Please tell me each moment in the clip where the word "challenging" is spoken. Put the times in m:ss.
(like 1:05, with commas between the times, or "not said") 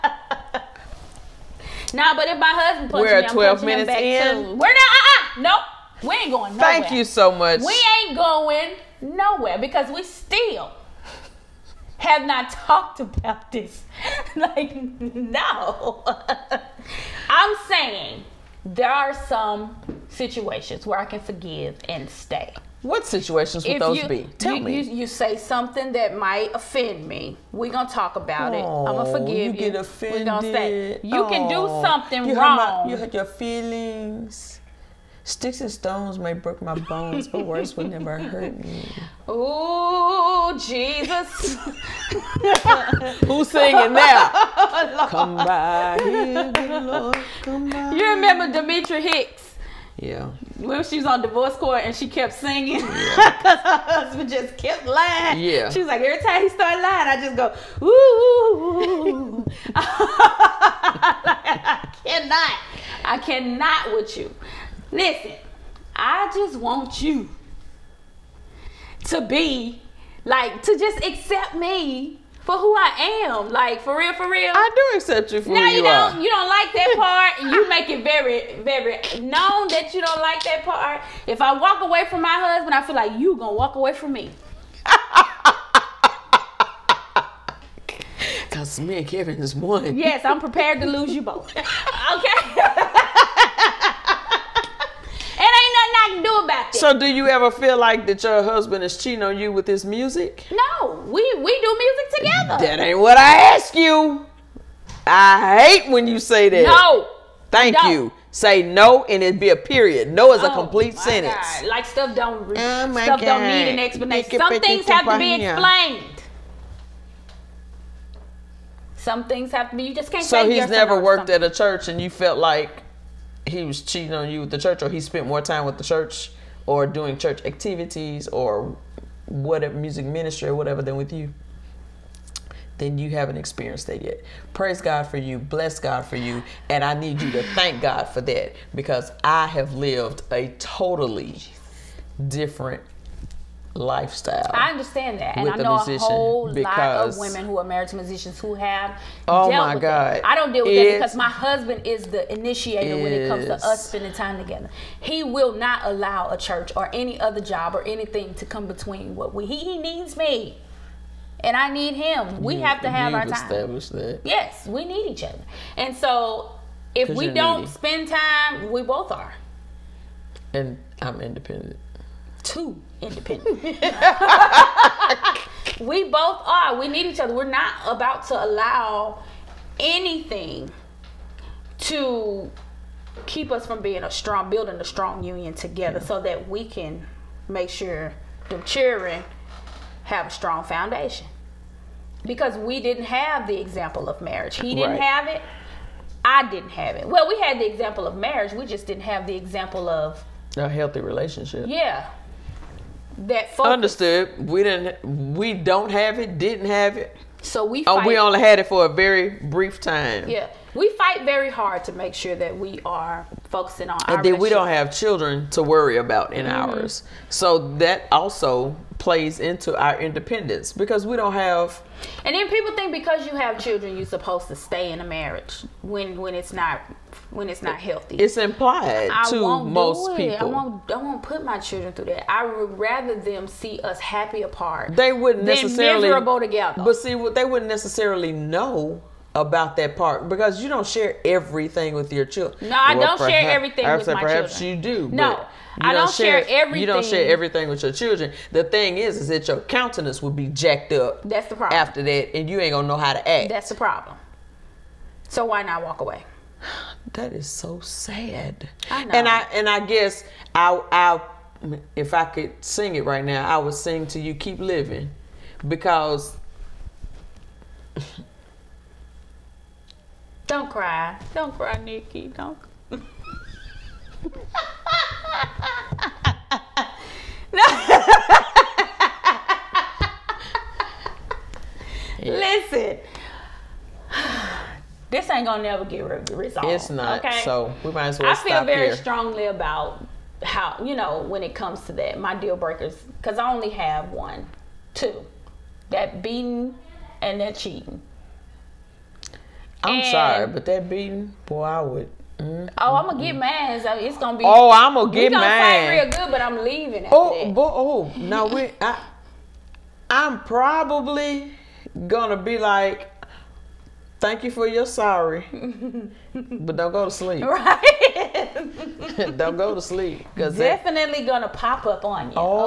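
not said.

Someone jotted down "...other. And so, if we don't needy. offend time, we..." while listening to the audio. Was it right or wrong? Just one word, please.
wrong.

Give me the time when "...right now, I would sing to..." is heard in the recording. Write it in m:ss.
4:23.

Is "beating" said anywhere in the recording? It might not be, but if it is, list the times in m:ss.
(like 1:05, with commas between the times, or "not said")
4:56, 5:00.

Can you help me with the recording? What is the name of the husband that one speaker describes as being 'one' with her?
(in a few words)
Kevin.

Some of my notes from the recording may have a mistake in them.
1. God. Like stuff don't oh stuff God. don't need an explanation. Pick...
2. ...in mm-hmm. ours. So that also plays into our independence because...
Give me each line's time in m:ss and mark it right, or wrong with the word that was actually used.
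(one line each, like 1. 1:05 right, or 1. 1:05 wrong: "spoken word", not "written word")
1. 1:51 right
2. 3:36 right.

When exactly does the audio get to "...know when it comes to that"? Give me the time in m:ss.
4:50.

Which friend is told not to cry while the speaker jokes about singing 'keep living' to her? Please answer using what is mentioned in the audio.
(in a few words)
Nikki.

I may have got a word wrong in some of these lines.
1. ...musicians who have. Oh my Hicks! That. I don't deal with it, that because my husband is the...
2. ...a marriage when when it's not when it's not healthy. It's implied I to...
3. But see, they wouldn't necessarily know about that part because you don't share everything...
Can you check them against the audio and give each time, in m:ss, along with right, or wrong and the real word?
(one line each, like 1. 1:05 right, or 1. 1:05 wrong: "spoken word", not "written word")
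1. 2:27 wrong: "God", not "Hicks"
2. 3:45 right
3. 3:56 right.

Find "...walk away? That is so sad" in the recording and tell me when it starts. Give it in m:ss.
4:15.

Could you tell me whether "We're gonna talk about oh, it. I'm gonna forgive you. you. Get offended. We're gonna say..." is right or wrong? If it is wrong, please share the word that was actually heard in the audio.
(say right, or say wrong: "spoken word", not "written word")
right.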